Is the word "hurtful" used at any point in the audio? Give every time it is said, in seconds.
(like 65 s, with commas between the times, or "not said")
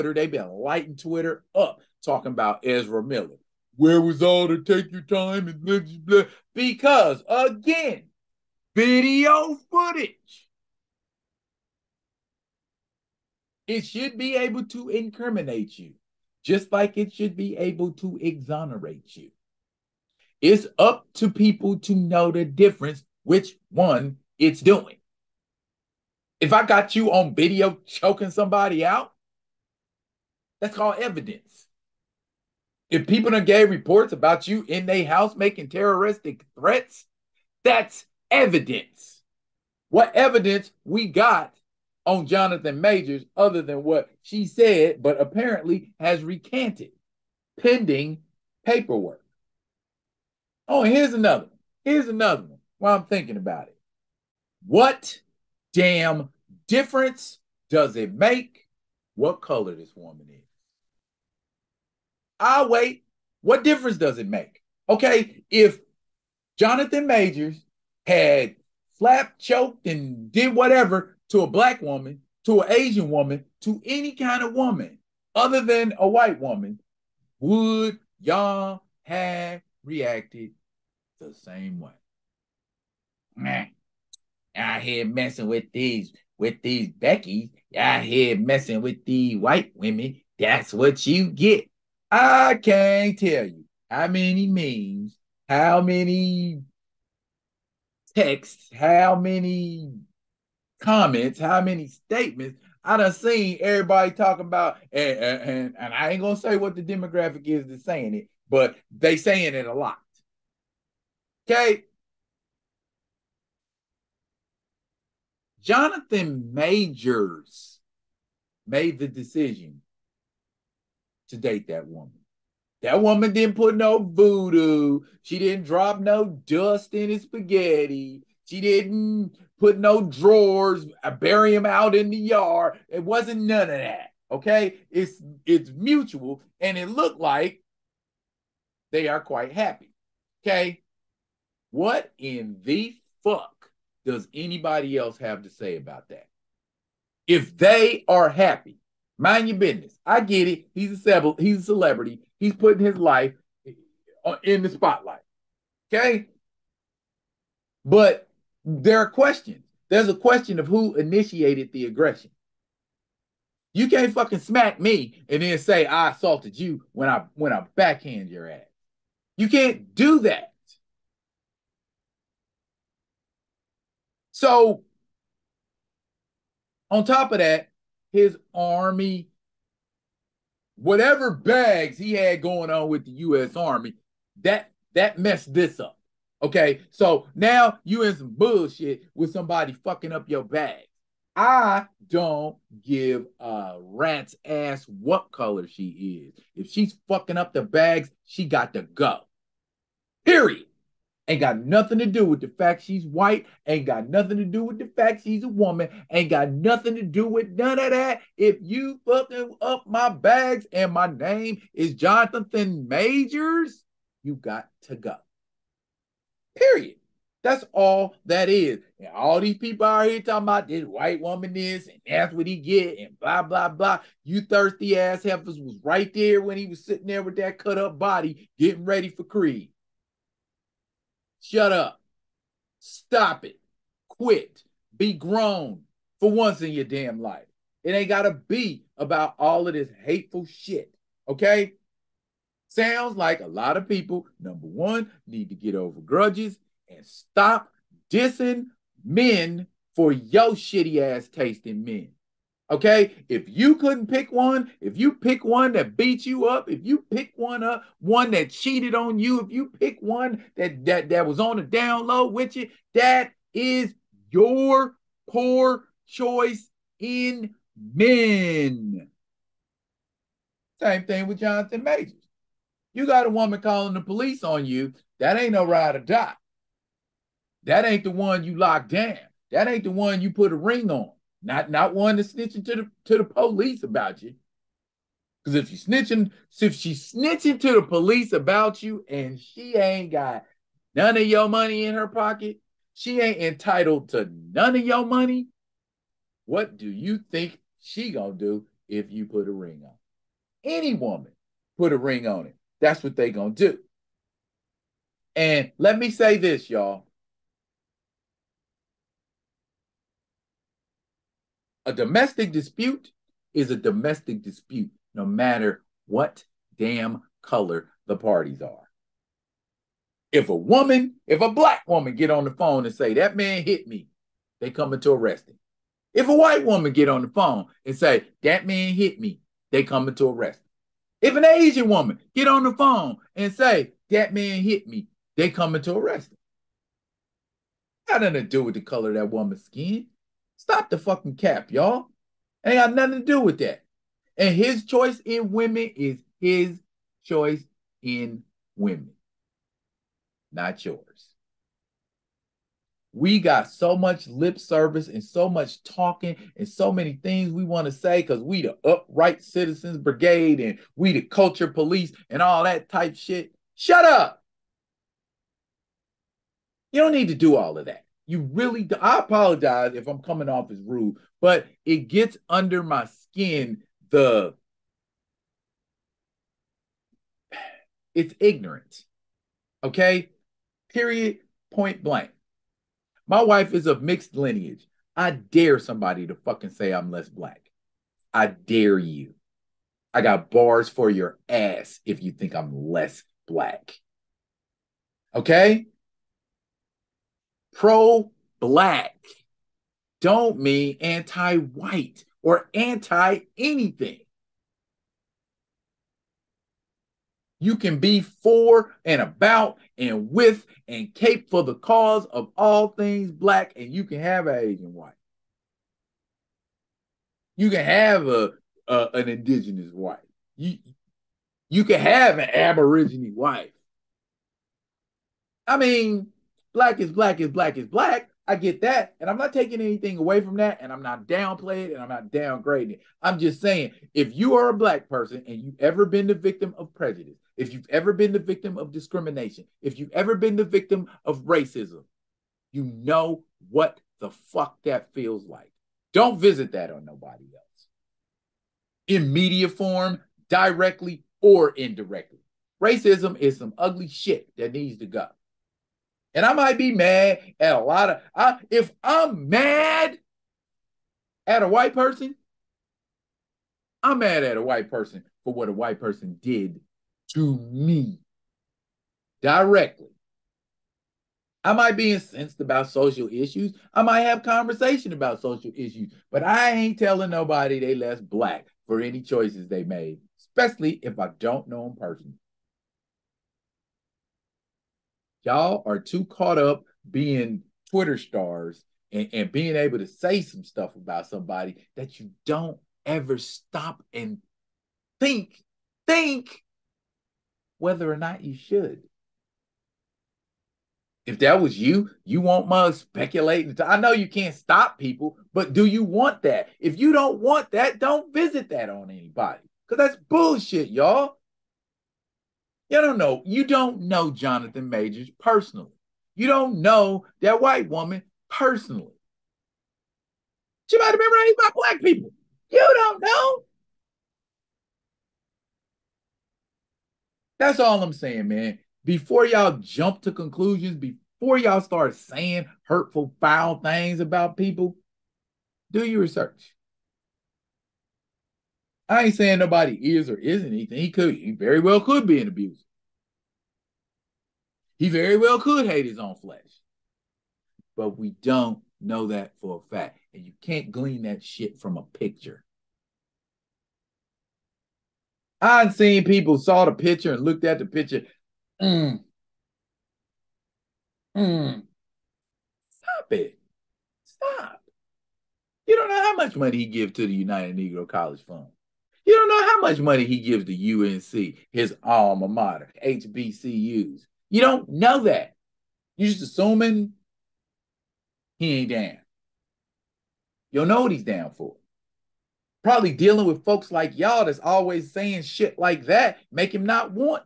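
532 s.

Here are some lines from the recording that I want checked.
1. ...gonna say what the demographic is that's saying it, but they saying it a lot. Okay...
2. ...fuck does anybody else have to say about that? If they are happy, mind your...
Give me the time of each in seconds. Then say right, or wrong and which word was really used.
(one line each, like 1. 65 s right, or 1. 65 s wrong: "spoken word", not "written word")
1. 106 s right
2. 143 s right.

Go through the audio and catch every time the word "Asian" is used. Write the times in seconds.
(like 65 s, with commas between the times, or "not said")
72 s, 331 s, 414 s.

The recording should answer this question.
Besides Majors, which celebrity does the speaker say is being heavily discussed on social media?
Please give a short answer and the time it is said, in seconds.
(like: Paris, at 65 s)
Ezra Miller, at 2 s.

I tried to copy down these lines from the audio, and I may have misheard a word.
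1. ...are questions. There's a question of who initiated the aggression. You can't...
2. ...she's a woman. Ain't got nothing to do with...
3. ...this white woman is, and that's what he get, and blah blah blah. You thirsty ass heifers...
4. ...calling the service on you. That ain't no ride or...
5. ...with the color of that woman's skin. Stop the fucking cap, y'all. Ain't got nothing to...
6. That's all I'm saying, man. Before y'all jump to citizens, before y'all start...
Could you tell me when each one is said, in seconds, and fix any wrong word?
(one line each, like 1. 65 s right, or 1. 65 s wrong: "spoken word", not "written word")
1. 158 s right
2. 205 s right
3. 220 s right
4. 273 s wrong: "police", not "service"
5. 338 s right
6. 527 s wrong: "conclusions", not "citizens".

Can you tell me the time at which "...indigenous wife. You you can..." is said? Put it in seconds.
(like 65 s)
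419 s.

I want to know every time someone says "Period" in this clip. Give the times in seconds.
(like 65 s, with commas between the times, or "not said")
200 s, 216 s, 380 s.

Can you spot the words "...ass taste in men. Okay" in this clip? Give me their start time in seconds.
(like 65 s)
250 s.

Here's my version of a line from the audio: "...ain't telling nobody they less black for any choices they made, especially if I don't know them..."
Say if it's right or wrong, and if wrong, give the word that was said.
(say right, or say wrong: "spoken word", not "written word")
right.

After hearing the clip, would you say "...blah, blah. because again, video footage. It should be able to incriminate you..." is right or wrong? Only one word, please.
right.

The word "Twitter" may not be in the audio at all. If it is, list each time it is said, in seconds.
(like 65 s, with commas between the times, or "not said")
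0 s, 487 s.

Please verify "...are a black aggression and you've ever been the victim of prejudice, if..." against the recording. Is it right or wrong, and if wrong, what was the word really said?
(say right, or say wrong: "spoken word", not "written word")
wrong: "person", not "aggression".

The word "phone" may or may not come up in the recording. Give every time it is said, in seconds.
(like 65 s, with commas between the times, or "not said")
322 s, 327 s, 332 s.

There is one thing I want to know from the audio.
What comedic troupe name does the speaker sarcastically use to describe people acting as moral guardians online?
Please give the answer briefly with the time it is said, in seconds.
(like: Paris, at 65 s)
Upright Citizens Brigade, at 358 s.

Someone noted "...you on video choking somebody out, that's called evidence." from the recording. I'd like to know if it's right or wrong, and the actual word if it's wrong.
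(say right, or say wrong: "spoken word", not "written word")
right.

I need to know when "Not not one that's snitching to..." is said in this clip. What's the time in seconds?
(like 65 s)
281 s.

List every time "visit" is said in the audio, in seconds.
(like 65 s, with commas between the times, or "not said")
446 s, 508 s.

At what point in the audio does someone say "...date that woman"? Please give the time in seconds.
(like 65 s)
121 s.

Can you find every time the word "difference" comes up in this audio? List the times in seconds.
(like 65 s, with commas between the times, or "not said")
22 s, 56 s, 63 s.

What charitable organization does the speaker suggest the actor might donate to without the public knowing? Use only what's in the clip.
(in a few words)
United Negro College Fund.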